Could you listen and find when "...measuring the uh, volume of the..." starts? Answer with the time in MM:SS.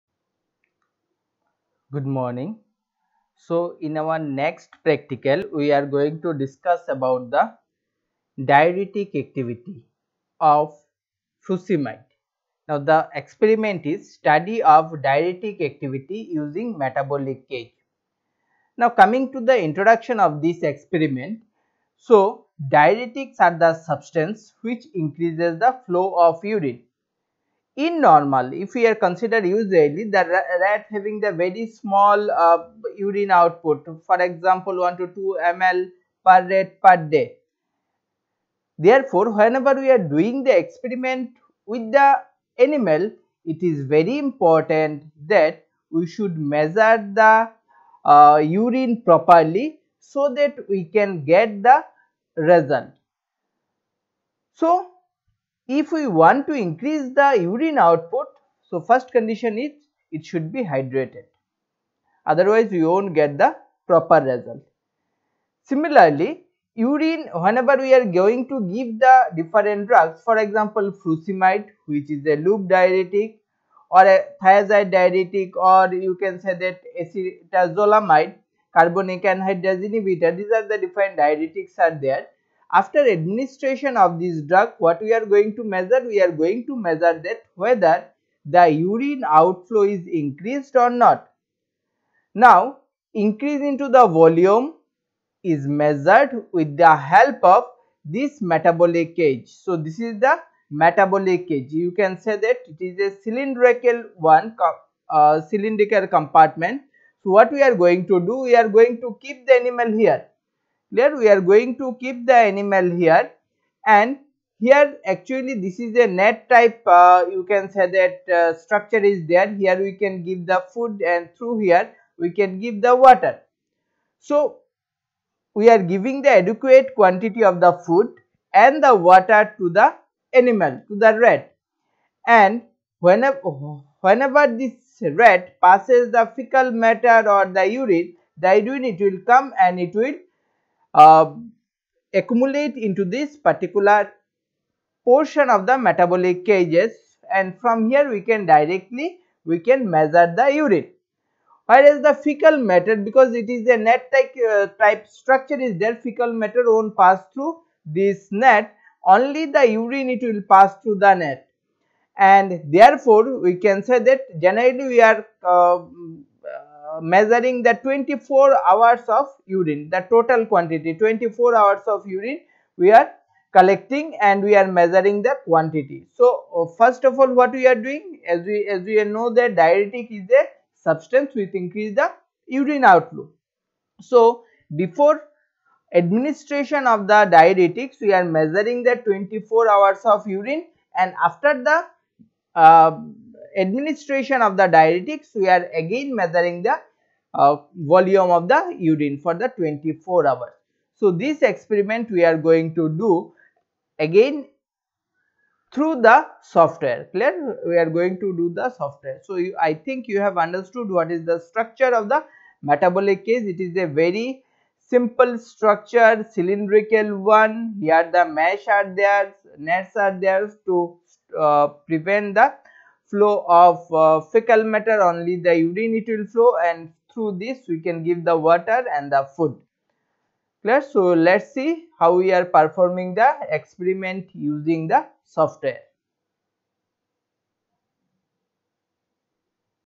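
03:16.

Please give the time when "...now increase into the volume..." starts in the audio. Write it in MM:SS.
01:32.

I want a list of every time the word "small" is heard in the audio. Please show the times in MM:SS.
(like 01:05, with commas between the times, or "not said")
00:31.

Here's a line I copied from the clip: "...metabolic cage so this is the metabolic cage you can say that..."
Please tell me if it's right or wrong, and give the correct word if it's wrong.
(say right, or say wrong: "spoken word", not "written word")
right.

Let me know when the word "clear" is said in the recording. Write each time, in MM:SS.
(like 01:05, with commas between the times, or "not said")
01:50, 03:27, 03:50.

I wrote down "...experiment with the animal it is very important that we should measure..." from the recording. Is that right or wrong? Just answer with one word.
right.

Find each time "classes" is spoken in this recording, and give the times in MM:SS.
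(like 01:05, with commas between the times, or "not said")
not said.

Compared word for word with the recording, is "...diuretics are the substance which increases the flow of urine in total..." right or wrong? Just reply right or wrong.
wrong.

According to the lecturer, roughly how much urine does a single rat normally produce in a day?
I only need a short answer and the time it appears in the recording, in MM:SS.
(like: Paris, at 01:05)
1 to 2 ml, at 00:34.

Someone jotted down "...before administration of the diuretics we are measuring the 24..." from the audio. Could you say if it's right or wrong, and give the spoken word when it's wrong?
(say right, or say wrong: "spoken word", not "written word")
right.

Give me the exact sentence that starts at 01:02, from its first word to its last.
Otherwise, we won't get the proper result.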